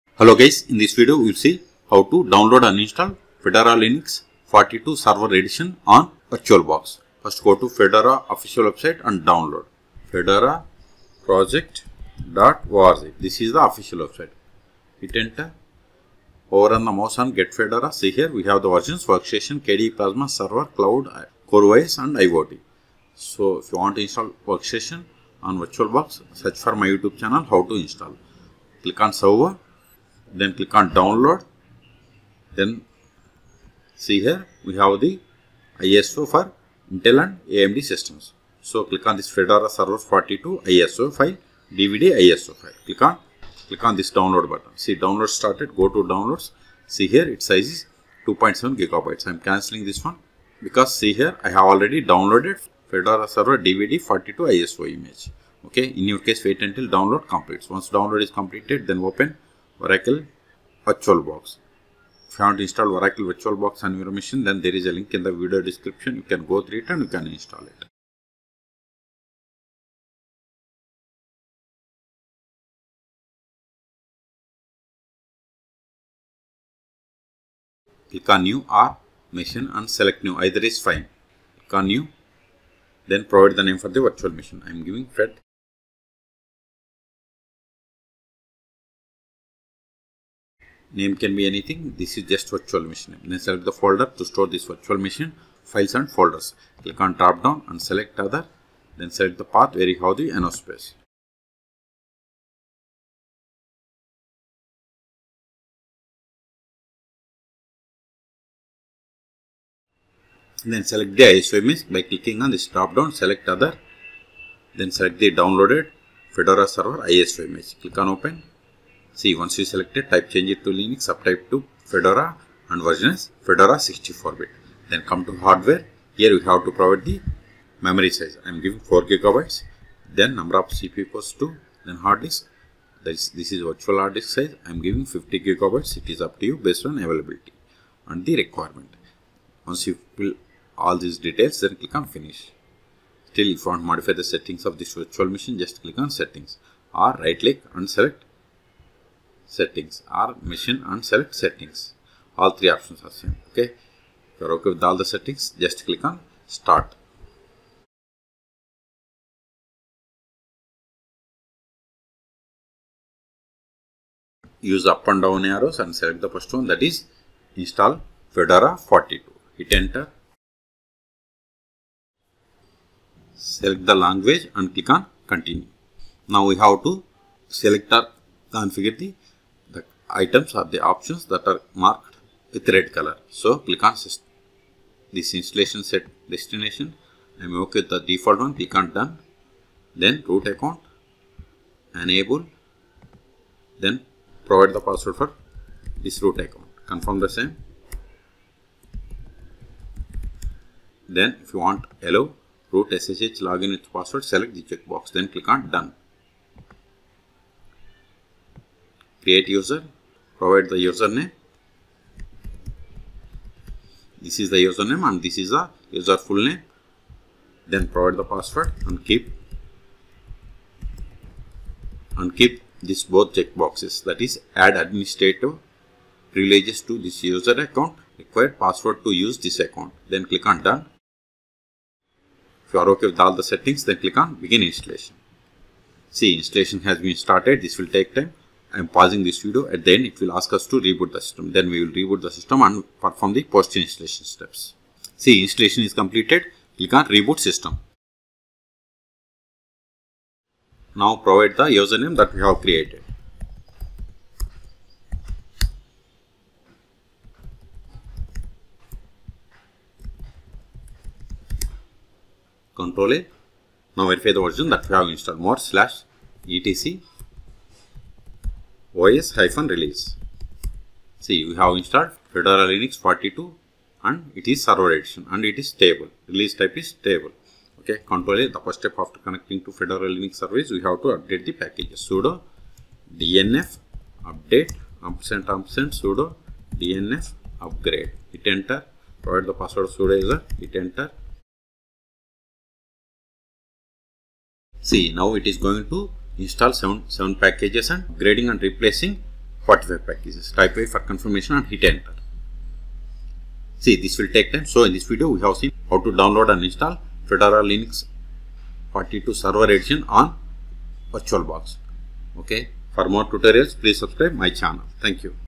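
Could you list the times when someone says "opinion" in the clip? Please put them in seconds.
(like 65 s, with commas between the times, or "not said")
not said.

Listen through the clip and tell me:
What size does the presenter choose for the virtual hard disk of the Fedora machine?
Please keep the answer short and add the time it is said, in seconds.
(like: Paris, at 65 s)
50 gigabytes, at 135 s.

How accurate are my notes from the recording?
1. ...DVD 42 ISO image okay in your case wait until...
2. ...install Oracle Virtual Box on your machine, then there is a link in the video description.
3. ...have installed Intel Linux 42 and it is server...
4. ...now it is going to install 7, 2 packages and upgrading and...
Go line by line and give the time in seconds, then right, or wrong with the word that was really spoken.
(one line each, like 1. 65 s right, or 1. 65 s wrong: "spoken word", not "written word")
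1. 53 s right
2. 62 s right
3. 271 s wrong: "Fedora", not "Intel"
4. 295 s wrong: "7", not "2".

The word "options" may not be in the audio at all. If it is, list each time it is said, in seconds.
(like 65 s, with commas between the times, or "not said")
152 s, 180 s.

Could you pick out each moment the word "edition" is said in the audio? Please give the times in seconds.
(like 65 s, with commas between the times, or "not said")
5 s, 274 s, 309 s.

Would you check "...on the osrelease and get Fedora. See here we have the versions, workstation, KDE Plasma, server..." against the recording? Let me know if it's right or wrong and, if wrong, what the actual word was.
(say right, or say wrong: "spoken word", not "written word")
wrong: "mouse", not "osrelease".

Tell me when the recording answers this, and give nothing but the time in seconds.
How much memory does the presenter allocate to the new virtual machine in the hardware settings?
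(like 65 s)
128 s.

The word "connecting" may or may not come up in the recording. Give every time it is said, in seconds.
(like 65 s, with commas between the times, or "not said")
279 s.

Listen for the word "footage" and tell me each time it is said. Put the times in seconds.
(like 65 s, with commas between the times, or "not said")
not said.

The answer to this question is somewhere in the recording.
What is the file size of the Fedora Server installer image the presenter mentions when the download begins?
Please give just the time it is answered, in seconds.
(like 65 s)
48 s.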